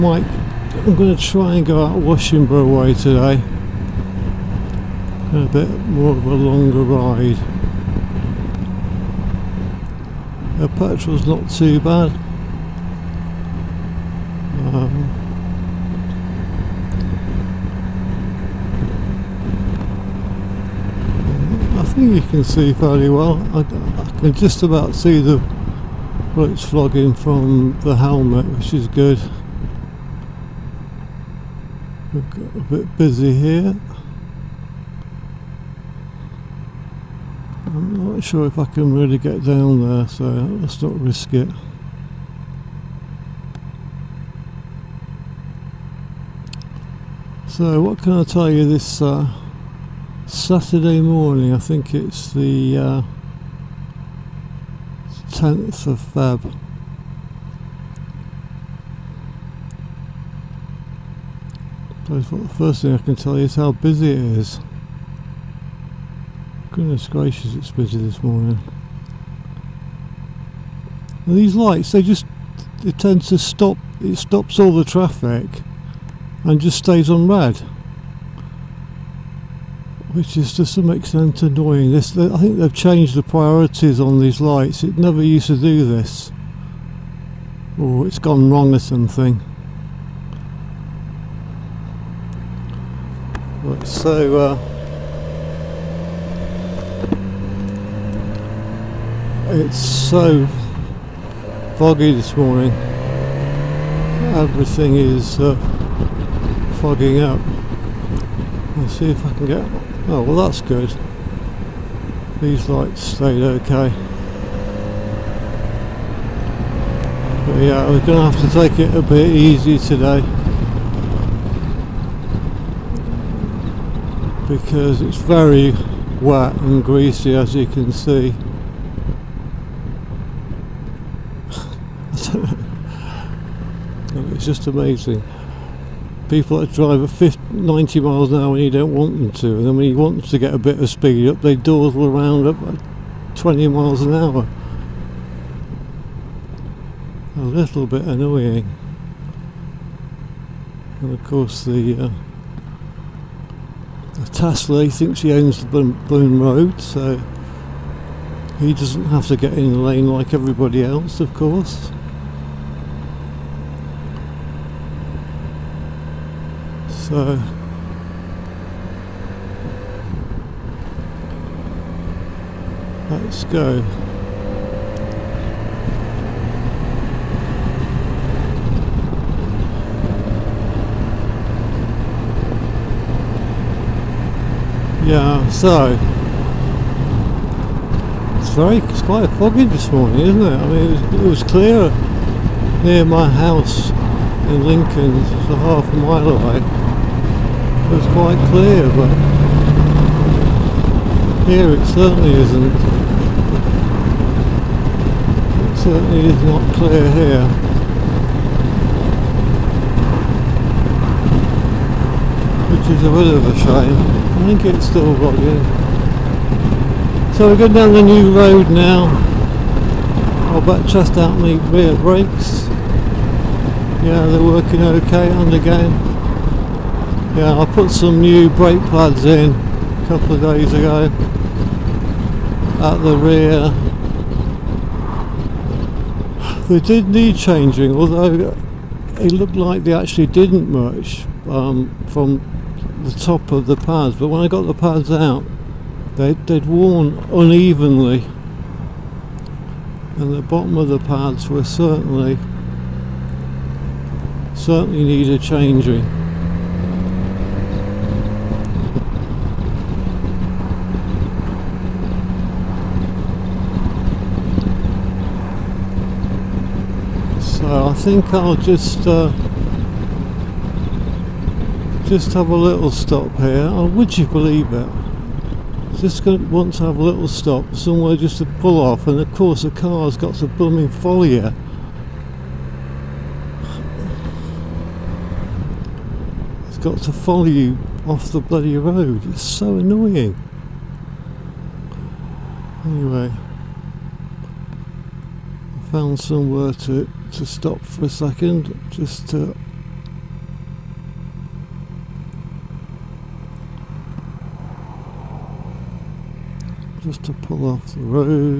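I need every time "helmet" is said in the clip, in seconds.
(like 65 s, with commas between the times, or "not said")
27 s.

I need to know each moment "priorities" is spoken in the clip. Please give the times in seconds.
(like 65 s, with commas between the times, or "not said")
83 s.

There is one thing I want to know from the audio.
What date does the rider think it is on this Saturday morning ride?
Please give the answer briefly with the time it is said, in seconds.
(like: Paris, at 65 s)
10th of February, at 55 s.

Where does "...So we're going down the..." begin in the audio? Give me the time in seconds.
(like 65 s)
217 s.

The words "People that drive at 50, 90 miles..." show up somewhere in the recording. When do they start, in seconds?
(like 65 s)
136 s.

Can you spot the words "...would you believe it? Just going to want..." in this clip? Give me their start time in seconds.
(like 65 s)
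273 s.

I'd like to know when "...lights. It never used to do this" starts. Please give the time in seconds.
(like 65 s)
84 s.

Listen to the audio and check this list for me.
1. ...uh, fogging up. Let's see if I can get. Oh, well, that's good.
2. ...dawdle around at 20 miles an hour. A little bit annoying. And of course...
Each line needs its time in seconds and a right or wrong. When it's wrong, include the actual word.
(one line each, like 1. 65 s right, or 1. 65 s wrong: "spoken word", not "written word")
1. 105 s right
2. 141 s right.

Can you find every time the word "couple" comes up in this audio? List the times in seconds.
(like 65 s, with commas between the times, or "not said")
230 s.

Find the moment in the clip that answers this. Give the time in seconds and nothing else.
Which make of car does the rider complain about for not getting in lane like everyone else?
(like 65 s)
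154 s.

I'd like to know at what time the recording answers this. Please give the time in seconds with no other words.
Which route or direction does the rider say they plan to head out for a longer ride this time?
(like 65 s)
1 s.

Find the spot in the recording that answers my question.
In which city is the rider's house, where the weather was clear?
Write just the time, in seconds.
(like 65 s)
194 s.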